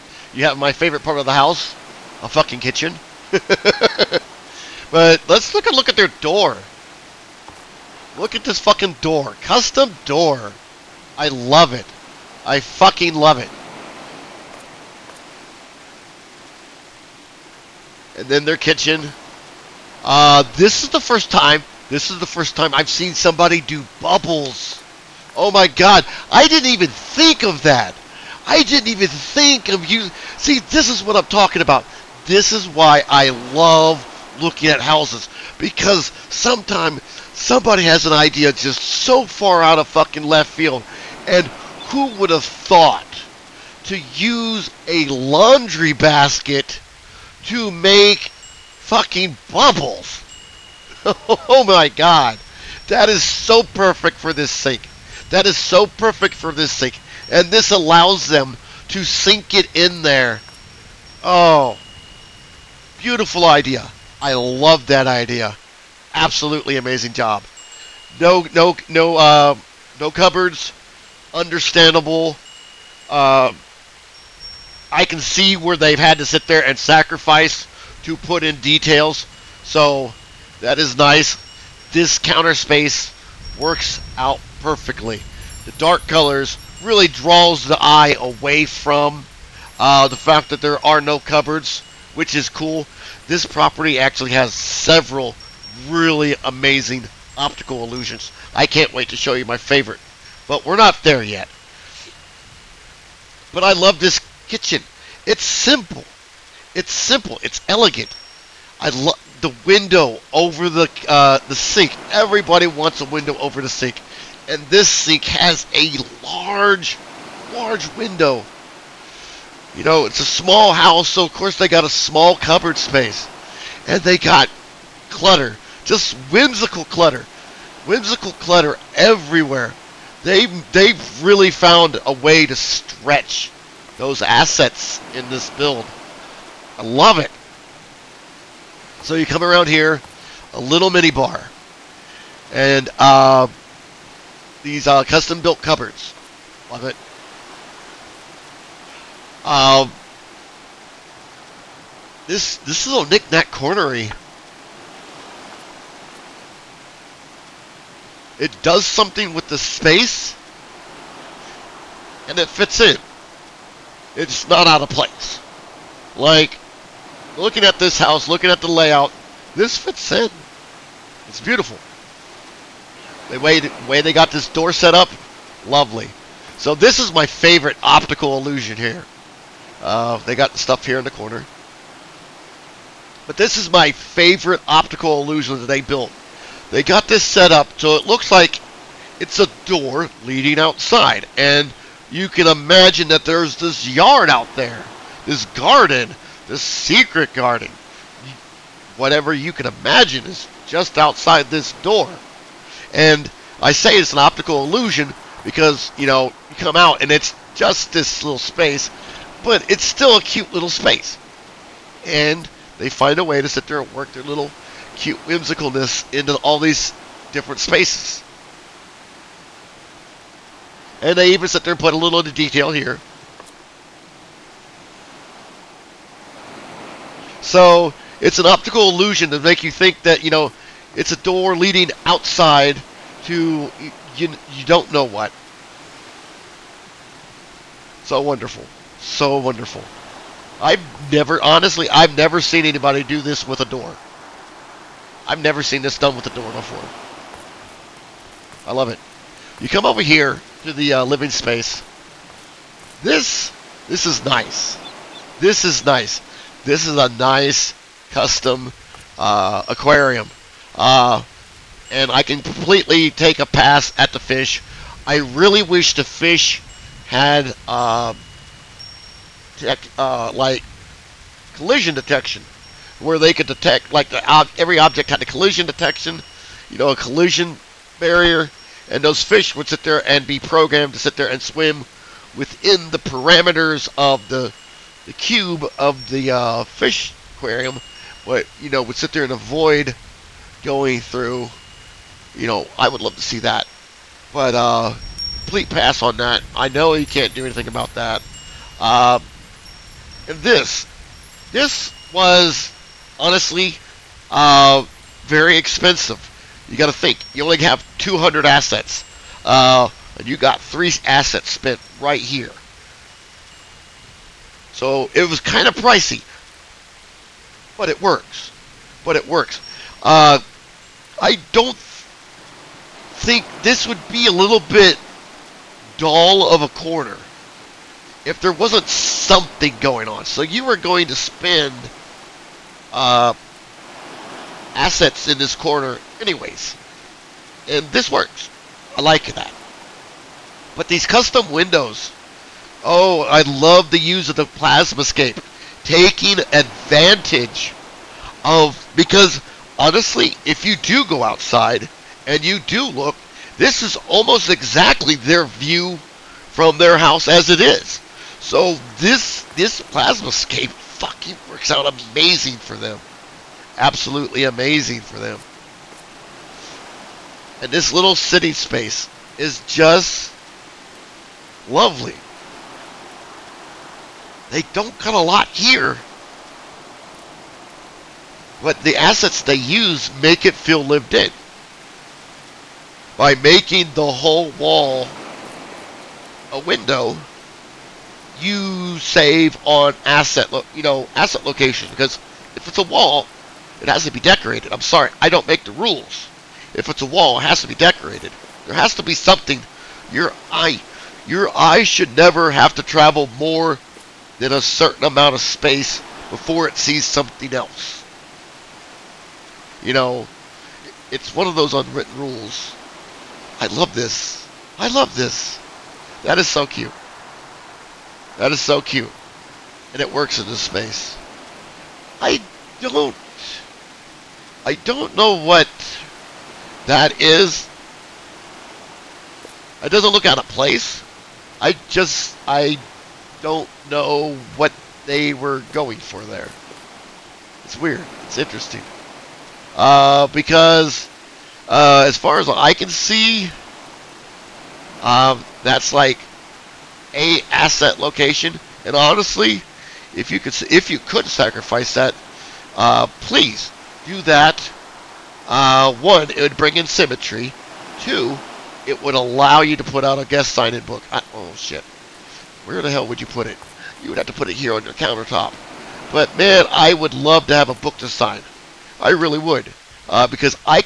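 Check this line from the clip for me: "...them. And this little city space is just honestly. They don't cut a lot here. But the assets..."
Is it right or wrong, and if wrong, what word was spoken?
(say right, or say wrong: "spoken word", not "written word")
wrong: "lovely", not "honestly".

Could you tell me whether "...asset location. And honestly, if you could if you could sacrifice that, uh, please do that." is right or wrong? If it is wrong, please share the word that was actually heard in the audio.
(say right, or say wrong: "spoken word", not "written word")
right.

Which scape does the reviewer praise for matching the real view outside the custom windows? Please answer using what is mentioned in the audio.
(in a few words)
Plasma scape.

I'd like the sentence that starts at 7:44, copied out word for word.
You would have to put it here on your countertop.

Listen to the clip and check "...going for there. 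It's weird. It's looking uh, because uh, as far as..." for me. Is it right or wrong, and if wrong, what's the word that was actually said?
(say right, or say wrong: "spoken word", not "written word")
wrong: "interesting", not "looking".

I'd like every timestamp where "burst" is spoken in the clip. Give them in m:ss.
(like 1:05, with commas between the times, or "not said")
not said.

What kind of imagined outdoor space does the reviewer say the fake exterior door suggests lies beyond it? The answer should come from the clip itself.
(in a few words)
Secret garden.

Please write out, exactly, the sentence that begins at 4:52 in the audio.
You know, I would love to see that.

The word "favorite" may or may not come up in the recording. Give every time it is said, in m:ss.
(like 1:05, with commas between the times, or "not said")
0:00, 1:39, 2:57, 3:03.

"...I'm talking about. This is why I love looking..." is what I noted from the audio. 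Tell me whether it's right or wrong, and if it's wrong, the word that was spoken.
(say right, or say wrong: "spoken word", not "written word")
right.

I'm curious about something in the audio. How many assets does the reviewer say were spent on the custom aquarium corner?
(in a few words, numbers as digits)
3.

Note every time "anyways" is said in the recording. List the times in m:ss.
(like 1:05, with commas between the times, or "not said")
5:36.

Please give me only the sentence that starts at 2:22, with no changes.
And uh, these uh, custom built cupboards.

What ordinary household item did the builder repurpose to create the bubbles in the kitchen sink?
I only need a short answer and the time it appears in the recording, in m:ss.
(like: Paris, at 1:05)
Laundry basket, at 0:45.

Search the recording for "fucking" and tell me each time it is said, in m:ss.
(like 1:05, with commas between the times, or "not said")
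0:02, 0:08, 0:12, 0:39, 0:48, 6:00.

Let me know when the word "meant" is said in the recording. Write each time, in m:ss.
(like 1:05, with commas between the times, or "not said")
not said.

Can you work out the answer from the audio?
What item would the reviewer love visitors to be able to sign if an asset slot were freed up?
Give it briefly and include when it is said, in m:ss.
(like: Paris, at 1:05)
Guest sign-in book, at 7:40.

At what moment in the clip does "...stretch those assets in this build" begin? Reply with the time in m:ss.
2:12.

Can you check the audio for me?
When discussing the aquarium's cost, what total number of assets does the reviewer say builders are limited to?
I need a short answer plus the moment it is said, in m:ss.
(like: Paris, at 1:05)
200, at 5:07.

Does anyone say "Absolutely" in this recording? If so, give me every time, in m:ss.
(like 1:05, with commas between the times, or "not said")
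1:06, 6:03.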